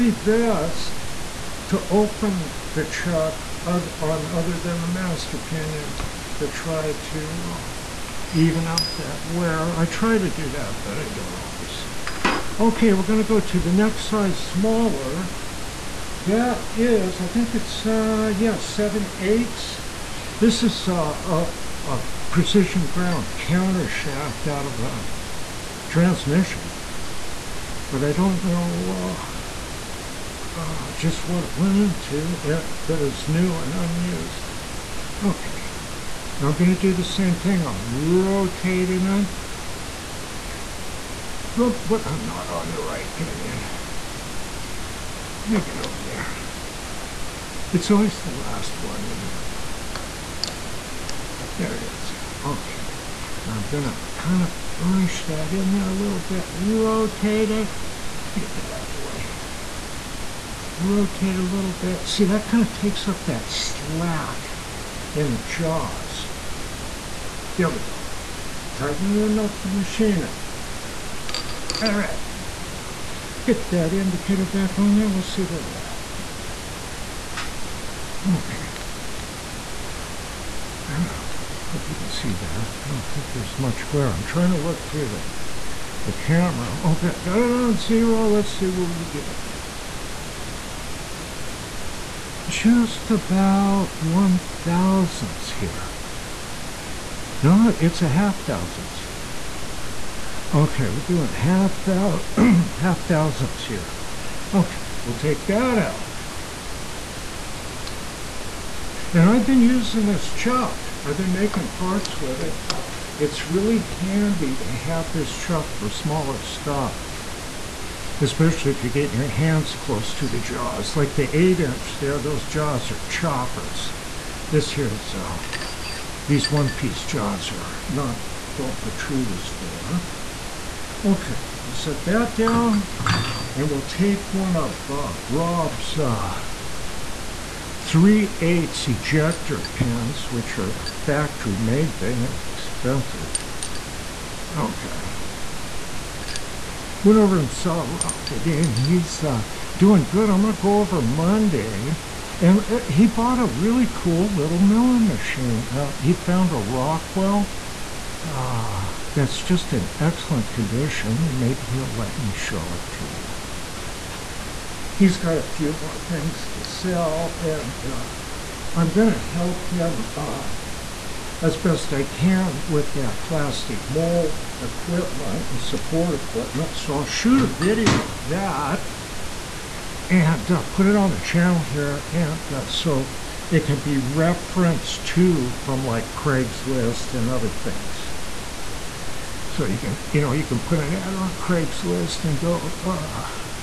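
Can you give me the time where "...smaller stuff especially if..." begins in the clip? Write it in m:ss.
1:55.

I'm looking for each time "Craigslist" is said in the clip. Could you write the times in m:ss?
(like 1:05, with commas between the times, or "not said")
3:06, 3:11.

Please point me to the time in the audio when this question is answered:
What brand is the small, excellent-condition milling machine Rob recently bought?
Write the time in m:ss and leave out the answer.
2:36.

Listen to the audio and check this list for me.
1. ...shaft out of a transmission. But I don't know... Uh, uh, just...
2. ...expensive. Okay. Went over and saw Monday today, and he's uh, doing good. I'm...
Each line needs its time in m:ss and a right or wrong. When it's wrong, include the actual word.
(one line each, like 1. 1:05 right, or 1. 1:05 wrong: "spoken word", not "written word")
1. 0:23 right
2. 2:22 wrong: "Rob", not "Monday".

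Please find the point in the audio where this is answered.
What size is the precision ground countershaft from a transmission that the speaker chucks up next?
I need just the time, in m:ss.
0:18.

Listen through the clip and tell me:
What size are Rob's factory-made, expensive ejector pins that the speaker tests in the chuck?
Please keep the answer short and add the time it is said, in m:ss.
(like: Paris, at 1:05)
3/8, at 2:17.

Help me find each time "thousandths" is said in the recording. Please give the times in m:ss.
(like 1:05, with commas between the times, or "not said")
1:34, 1:38, 1:43.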